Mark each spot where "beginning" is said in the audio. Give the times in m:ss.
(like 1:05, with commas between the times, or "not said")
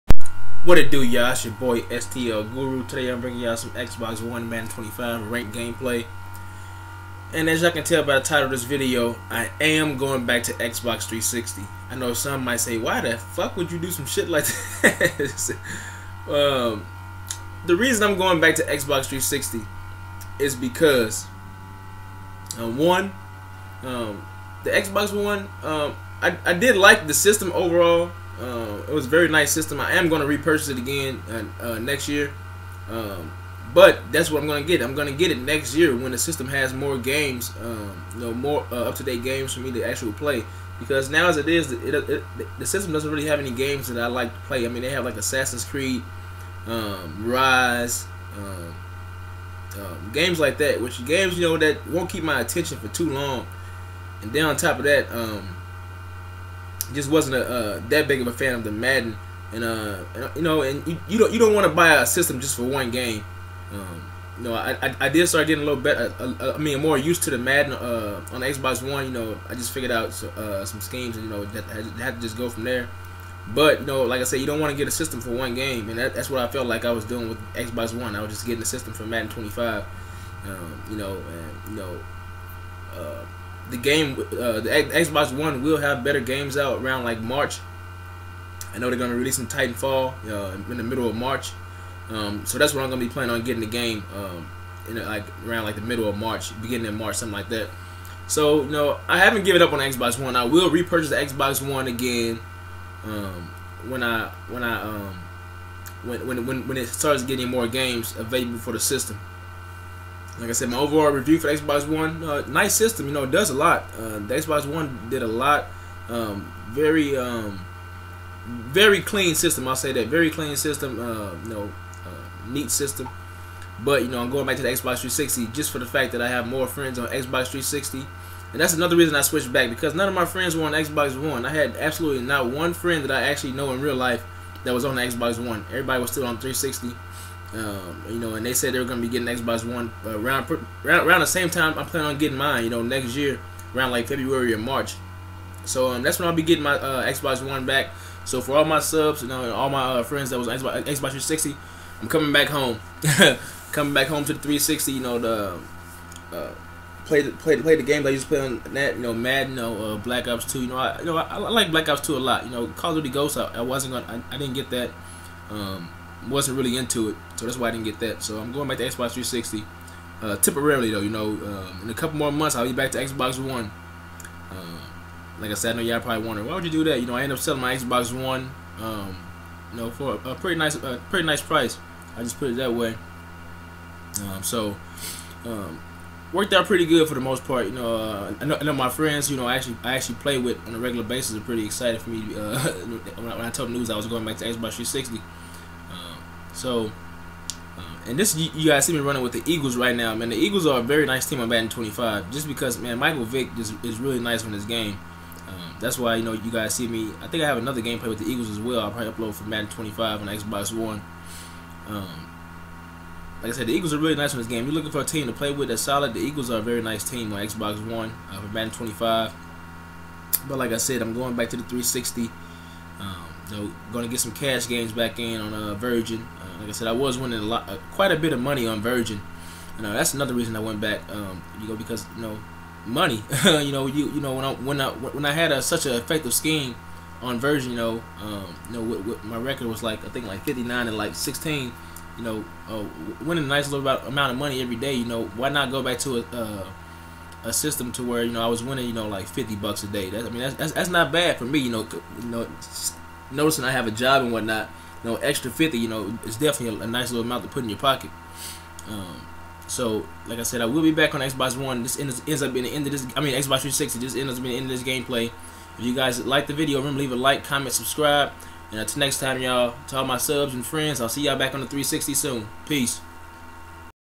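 1:36.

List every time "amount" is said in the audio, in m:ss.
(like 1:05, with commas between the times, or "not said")
4:03, 4:17.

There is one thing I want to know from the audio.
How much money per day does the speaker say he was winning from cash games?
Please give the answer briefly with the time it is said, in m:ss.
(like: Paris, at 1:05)
$50, at 4:09.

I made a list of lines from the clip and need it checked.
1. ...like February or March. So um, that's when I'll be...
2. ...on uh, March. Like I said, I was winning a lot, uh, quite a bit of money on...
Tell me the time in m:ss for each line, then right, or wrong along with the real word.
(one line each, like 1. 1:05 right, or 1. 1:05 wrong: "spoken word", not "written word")
1. 2:23 right
2. 3:45 wrong: "Virgin", not "March".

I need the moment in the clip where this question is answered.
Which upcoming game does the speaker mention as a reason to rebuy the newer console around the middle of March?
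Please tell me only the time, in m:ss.
1:29.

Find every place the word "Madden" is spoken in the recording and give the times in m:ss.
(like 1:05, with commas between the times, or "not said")
0:04, 0:58, 1:07, 1:19, 2:39, 3:29, 3:38.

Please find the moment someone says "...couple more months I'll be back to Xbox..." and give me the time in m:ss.
2:51.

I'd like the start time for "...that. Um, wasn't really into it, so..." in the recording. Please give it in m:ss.
2:44.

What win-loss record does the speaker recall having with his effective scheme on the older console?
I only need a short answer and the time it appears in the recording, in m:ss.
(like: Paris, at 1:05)
59 and 16, at 4:00.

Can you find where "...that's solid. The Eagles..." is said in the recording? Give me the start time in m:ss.
3:35.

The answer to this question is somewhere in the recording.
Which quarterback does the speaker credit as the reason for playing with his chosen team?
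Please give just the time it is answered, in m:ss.
3:22.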